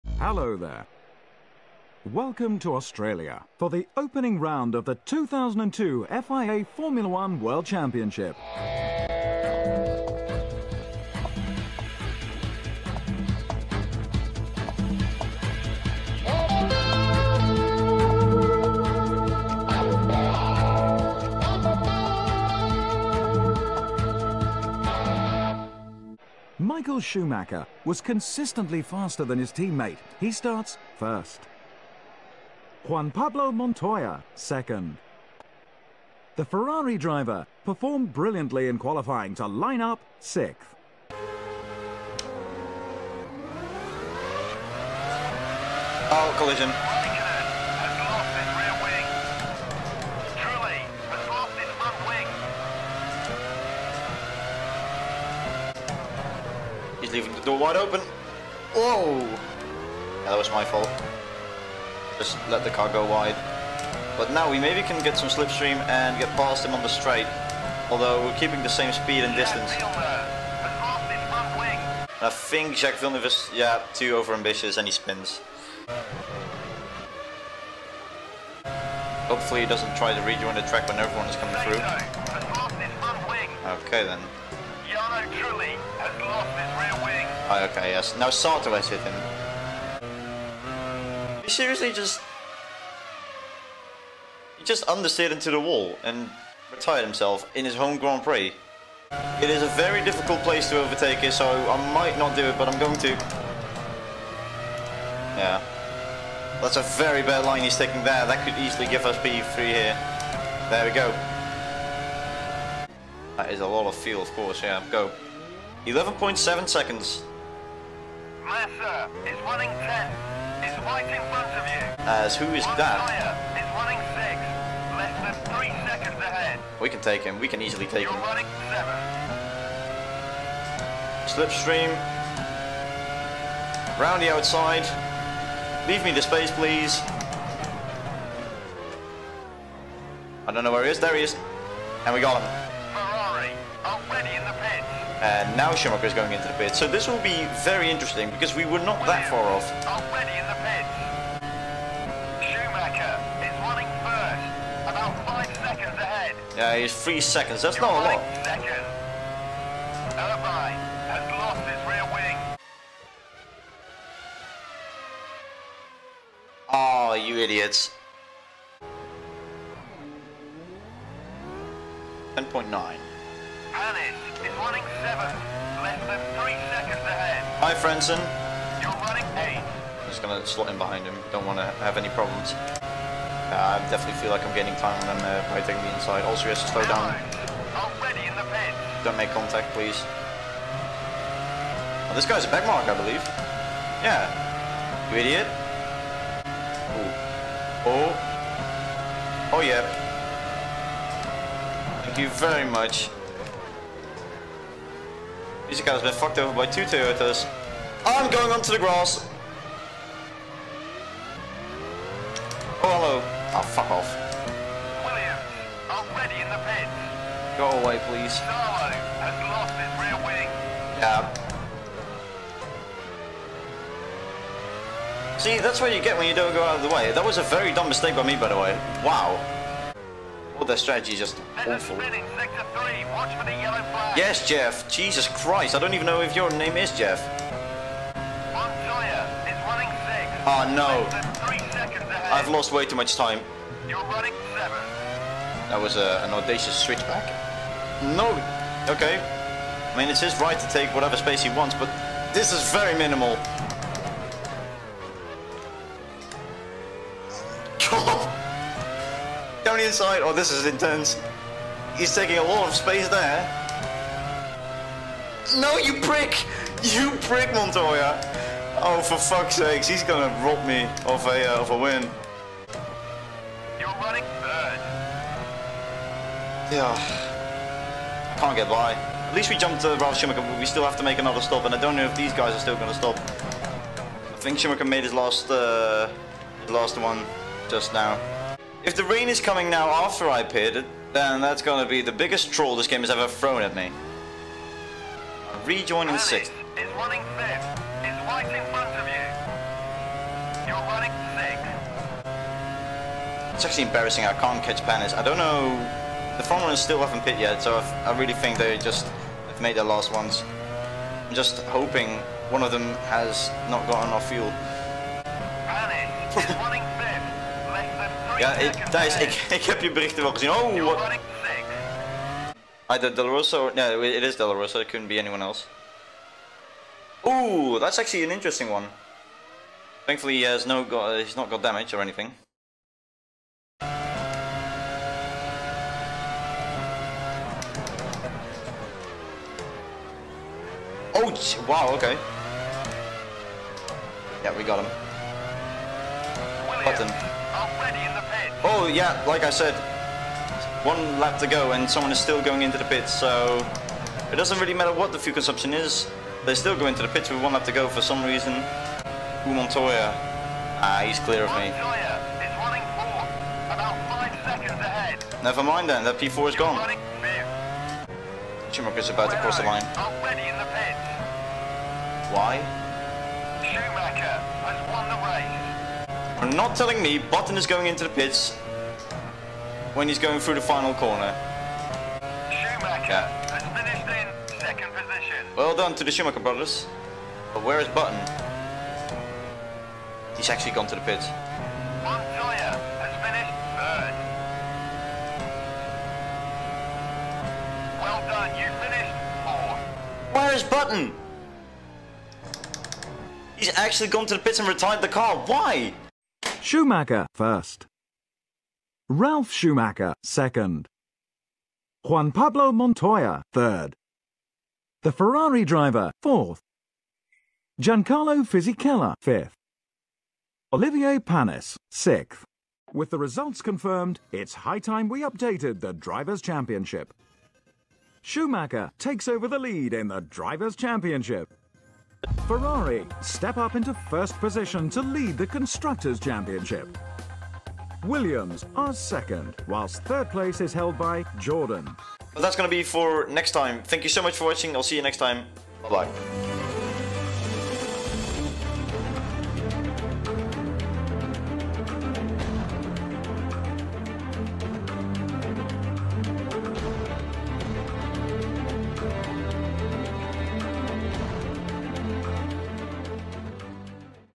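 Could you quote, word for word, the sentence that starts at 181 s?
Don't want to have any problems.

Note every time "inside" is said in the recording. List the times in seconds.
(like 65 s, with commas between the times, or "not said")
185 s, 259 s.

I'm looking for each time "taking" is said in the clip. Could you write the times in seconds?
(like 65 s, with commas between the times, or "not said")
107 s, 185 s, 262 s.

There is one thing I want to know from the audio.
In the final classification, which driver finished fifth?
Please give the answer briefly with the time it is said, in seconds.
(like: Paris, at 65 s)
Giancarlo Fisichella, at 417 s.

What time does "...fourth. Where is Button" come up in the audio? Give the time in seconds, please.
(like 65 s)
399 s.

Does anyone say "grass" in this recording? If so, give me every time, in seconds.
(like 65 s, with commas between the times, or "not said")
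208 s.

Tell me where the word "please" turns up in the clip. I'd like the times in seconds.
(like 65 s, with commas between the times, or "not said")
136 s, 189 s, 218 s.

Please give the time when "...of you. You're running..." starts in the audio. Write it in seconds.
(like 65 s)
298 s.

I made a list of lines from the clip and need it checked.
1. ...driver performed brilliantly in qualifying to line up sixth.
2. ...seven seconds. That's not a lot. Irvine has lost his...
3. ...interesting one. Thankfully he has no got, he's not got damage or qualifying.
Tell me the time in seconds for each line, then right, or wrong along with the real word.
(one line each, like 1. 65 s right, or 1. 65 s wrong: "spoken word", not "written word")
1. 36 s right
2. 157 s wrong: "three", not "seven"
3. 328 s wrong: "anything", not "qualifying".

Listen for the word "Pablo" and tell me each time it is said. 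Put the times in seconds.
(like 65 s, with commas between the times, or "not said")
33 s, 412 s.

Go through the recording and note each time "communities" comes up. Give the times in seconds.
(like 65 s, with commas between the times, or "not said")
not said.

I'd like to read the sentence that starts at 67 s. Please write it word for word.
Although we're keeping the same speed and distance.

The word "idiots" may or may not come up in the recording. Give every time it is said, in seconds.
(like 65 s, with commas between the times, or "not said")
167 s, 195 s.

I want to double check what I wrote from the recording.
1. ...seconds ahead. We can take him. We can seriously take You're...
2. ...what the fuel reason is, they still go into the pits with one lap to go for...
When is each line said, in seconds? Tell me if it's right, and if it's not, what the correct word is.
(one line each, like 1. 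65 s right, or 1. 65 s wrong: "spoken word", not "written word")
1. 125 s wrong: "easily", not "seriously"
2. 354 s wrong: "consumption", not "reason".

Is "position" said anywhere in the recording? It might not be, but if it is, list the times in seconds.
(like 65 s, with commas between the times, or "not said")
384 s, 434 s.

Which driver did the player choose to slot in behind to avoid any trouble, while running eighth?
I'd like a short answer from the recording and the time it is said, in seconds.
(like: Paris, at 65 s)
Frentzen, at 177 s.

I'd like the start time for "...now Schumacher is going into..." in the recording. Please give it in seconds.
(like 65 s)
145 s.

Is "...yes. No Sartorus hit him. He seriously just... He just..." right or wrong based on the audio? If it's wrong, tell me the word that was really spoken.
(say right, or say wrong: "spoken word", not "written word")
right.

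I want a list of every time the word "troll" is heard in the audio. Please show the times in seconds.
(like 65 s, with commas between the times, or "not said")
292 s.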